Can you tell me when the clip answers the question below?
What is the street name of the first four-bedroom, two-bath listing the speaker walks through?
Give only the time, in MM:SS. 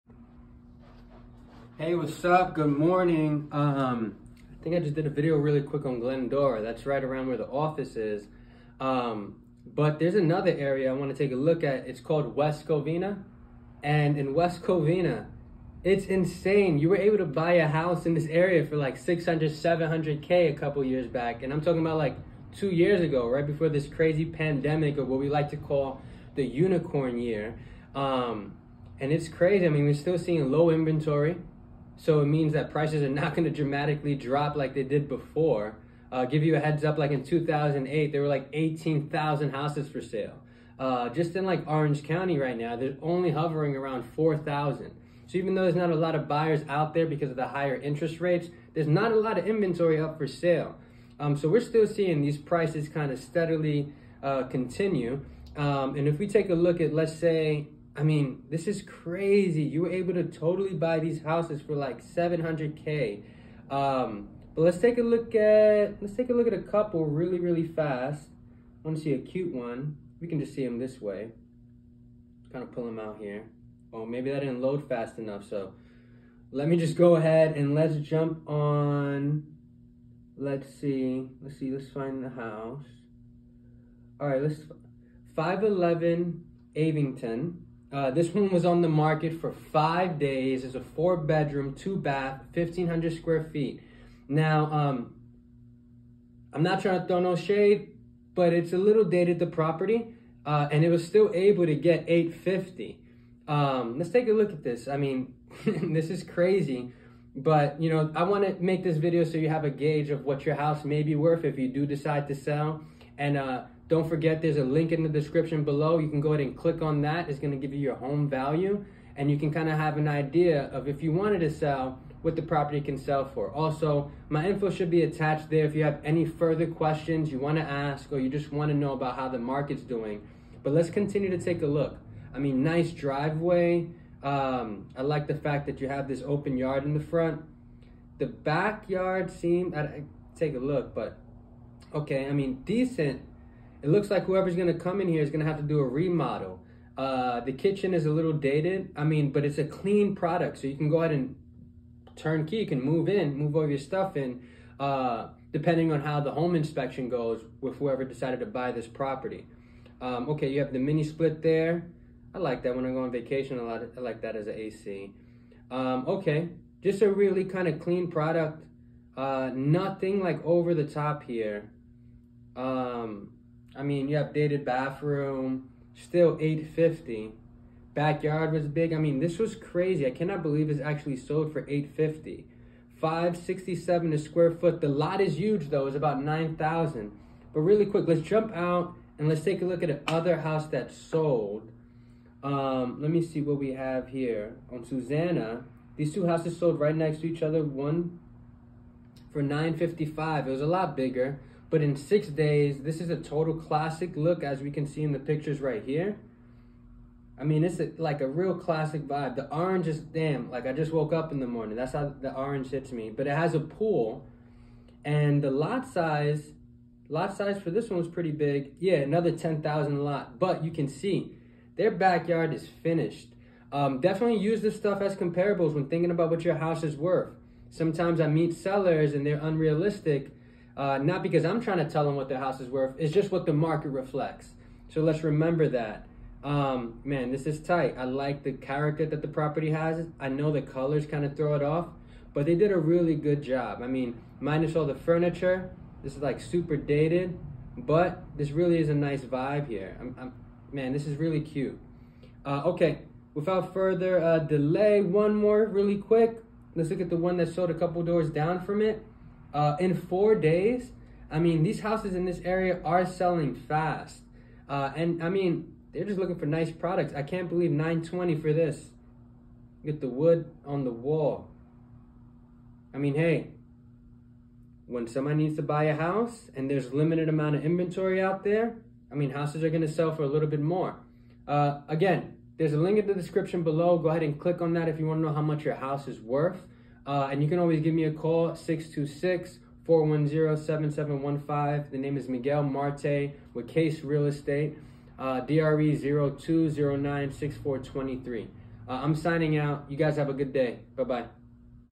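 01:26.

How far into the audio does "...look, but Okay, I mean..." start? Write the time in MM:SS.
02:20.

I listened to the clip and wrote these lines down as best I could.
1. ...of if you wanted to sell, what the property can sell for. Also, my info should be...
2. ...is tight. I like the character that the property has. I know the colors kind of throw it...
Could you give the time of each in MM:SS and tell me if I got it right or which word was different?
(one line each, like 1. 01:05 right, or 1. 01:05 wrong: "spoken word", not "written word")
1. 02:00 right
2. 03:57 right.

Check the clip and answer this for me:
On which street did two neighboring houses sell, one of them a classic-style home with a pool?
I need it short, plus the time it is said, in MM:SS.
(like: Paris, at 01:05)
Susanna, at 03:14.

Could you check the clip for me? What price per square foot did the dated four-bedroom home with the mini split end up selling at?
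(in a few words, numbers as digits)
567.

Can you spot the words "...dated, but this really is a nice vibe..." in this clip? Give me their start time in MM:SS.
04:06.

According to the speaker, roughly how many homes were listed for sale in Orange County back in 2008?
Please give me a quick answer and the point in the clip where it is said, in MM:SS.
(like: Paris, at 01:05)
18,000, at 00:38.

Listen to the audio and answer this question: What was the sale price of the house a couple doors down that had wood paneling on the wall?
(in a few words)
920.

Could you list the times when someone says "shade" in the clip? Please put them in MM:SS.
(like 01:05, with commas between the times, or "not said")
01:37.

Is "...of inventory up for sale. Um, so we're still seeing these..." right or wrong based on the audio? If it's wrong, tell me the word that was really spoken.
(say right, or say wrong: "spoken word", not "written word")
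right.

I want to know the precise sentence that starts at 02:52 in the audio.
Um, I mean, you updated bathroom, still 850.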